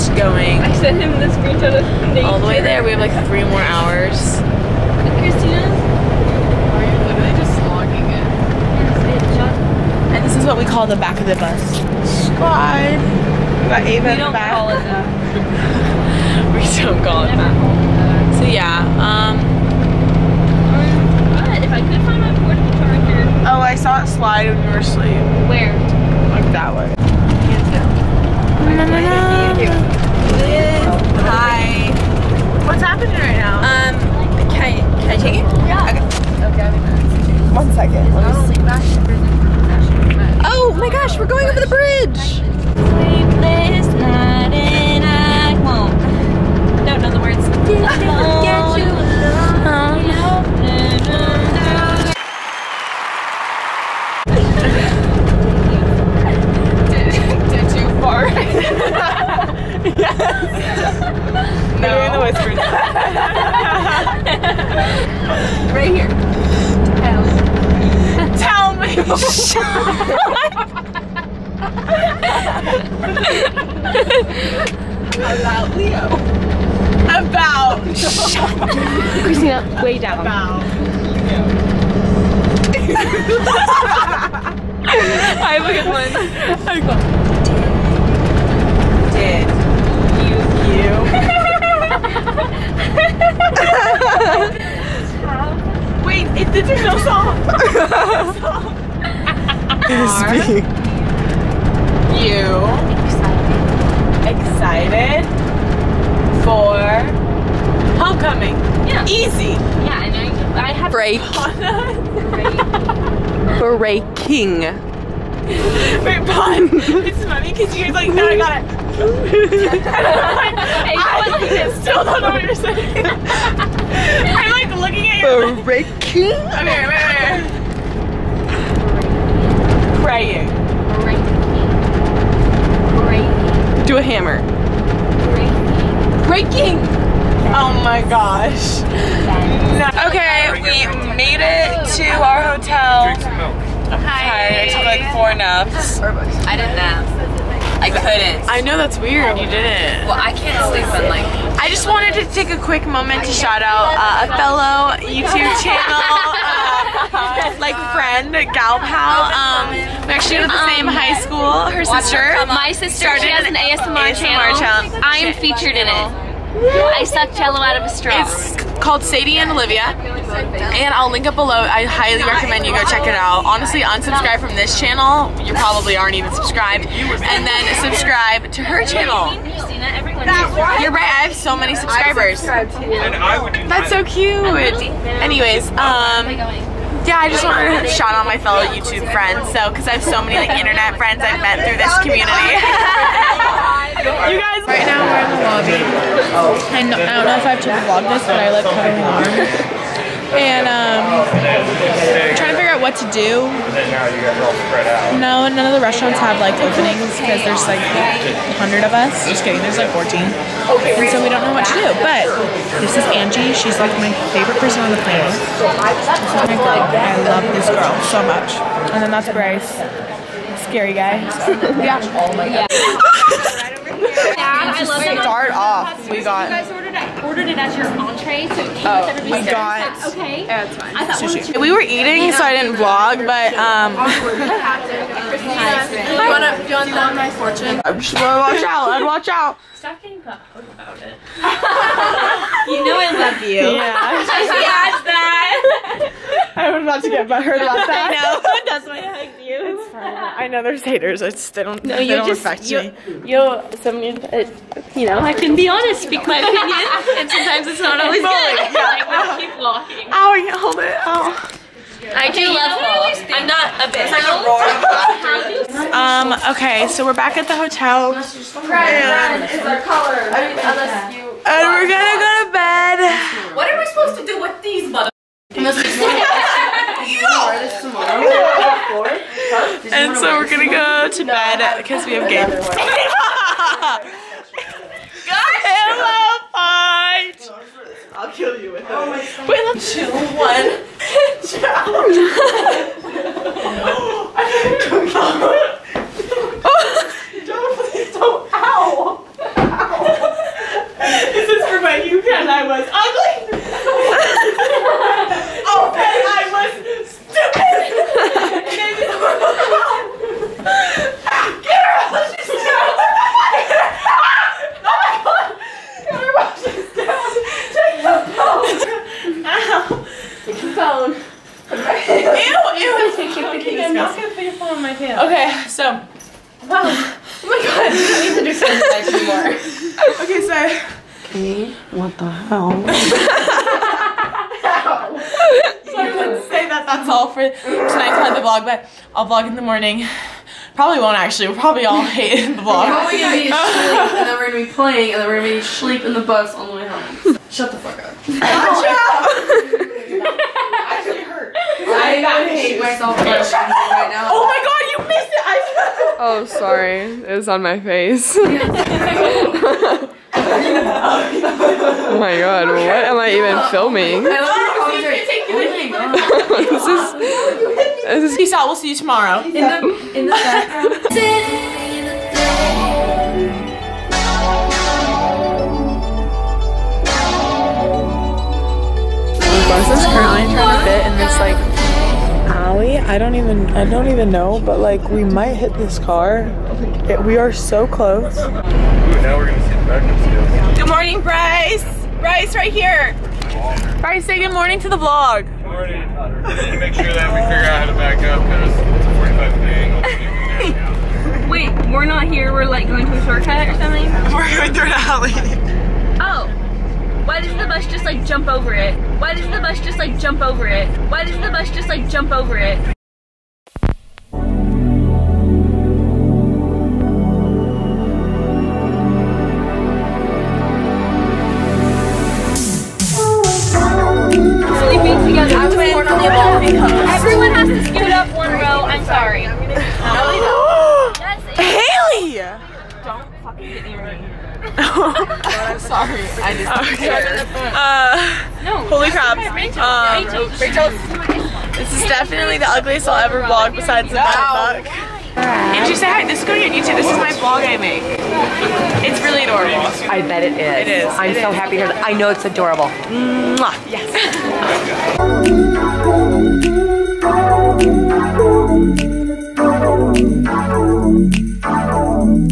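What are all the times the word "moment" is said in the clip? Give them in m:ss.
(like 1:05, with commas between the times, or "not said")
2:32.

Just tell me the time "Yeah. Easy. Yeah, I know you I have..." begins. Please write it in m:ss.
1:48.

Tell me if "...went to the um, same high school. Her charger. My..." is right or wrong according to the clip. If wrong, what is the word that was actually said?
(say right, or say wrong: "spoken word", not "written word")
wrong: "sister", not "charger".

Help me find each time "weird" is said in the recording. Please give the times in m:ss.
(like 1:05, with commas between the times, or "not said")
2:28.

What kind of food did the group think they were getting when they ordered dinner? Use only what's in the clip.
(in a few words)
Sushi.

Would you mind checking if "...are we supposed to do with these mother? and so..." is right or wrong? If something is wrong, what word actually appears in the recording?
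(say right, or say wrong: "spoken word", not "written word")
right.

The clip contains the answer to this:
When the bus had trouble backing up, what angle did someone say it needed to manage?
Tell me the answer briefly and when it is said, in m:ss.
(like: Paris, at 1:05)
45 degrees, at 6:39.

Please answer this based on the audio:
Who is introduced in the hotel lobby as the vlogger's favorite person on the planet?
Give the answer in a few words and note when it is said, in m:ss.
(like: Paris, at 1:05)
Angie, at 3:33.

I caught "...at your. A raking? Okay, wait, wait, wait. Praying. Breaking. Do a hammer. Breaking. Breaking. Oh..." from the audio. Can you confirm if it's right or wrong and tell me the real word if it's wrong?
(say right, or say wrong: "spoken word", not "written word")
right.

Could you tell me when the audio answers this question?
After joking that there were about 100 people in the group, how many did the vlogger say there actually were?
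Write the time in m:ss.
3:29.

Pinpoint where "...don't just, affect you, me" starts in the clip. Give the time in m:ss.
4:12.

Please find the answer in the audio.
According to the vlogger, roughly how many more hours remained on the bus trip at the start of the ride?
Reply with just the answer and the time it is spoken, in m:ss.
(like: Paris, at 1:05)
3, at 0:03.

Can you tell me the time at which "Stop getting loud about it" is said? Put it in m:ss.
3:59.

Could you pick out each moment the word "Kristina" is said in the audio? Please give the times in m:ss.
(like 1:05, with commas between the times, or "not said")
0:05, 1:19.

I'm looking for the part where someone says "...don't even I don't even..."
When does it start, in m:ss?
6:23.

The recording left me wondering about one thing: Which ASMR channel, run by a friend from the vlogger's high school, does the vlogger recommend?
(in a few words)
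Sadie and Olivia.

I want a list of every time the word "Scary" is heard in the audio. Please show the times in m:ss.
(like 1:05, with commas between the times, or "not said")
3:40.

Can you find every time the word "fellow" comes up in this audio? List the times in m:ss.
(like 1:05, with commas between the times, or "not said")
2:34, 3:08.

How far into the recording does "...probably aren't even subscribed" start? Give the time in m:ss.
2:55.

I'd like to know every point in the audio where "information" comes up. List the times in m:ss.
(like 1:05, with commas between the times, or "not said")
not said.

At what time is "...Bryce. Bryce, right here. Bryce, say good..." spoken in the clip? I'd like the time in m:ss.
6:31.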